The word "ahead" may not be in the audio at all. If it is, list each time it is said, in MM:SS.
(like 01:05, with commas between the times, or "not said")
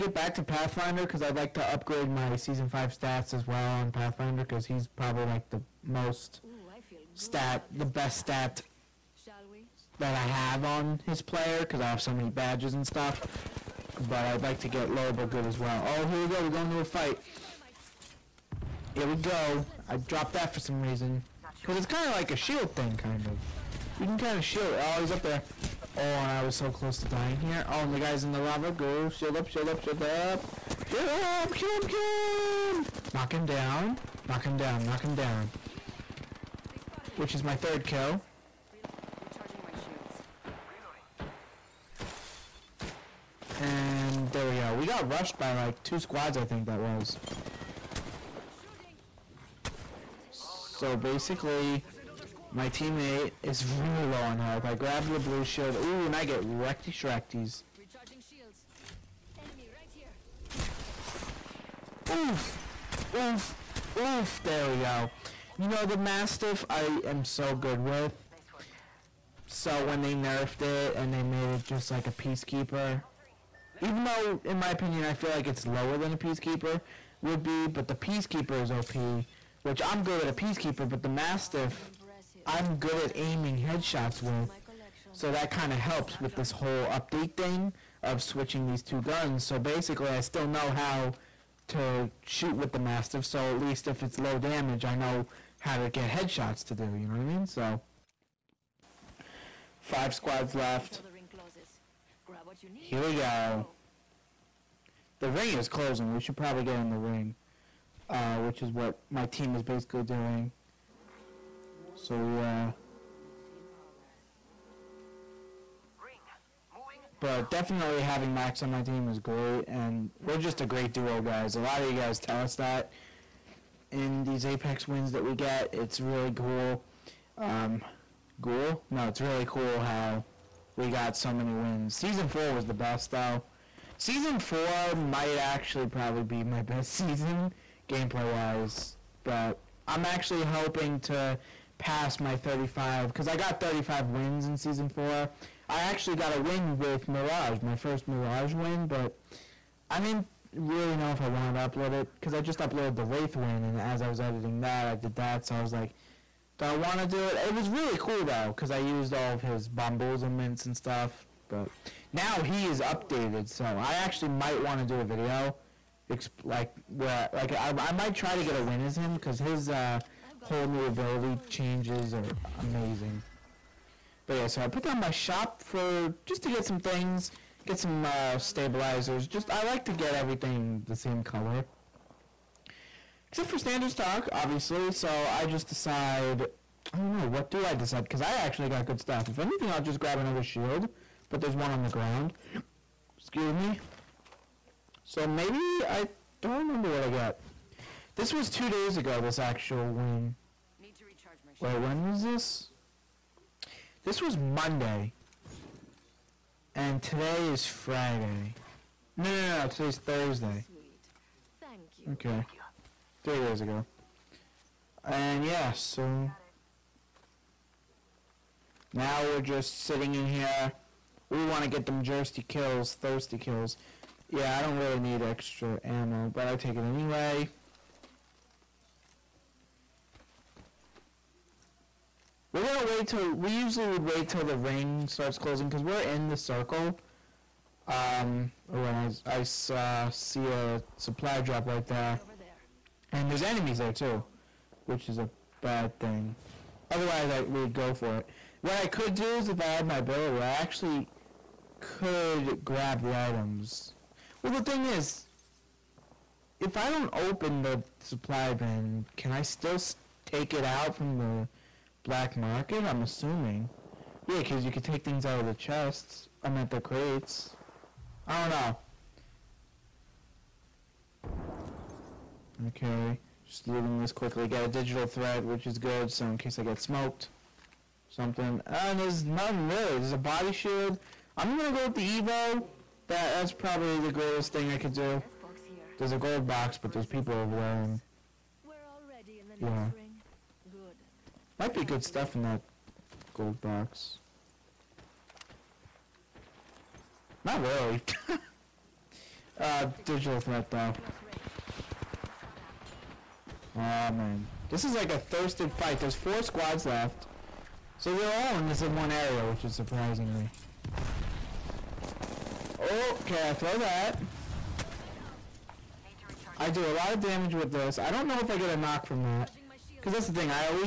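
not said.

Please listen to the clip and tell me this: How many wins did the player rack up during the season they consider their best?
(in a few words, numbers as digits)
35.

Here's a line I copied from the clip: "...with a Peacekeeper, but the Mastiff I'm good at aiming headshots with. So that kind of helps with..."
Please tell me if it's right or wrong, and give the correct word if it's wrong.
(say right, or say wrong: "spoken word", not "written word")
right.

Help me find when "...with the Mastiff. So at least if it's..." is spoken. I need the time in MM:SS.
01:32.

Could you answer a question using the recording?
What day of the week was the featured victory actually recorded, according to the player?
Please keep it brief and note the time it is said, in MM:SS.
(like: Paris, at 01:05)
Monday, at 03:24.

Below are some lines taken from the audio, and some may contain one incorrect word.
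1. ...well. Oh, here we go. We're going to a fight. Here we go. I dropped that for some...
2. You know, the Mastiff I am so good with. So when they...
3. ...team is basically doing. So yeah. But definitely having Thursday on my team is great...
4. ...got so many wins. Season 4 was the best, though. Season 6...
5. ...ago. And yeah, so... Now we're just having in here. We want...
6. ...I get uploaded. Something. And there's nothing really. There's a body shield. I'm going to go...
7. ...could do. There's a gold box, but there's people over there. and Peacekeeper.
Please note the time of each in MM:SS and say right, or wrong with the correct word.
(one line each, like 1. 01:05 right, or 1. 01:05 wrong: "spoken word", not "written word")
1. 00:15 right
2. 01:05 right
3. 01:49 wrong: "Max", not "Thursday"
4. 02:10 wrong: "4", not "6"
5. 03:33 wrong: "sitting", not "having"
6. 04:36 wrong: "smoked", not "uploaded"
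7. 04:44 wrong: "Yeah", not "Peacekeeper".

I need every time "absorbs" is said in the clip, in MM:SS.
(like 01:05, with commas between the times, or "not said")
not said.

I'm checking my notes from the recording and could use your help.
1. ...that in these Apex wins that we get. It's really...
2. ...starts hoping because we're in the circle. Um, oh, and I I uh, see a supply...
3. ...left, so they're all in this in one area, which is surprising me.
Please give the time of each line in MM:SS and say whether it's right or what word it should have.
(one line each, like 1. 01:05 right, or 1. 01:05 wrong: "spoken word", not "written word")
1. 02:02 right
2. 03:55 wrong: "closing", not "hoping"
3. 05:06 right.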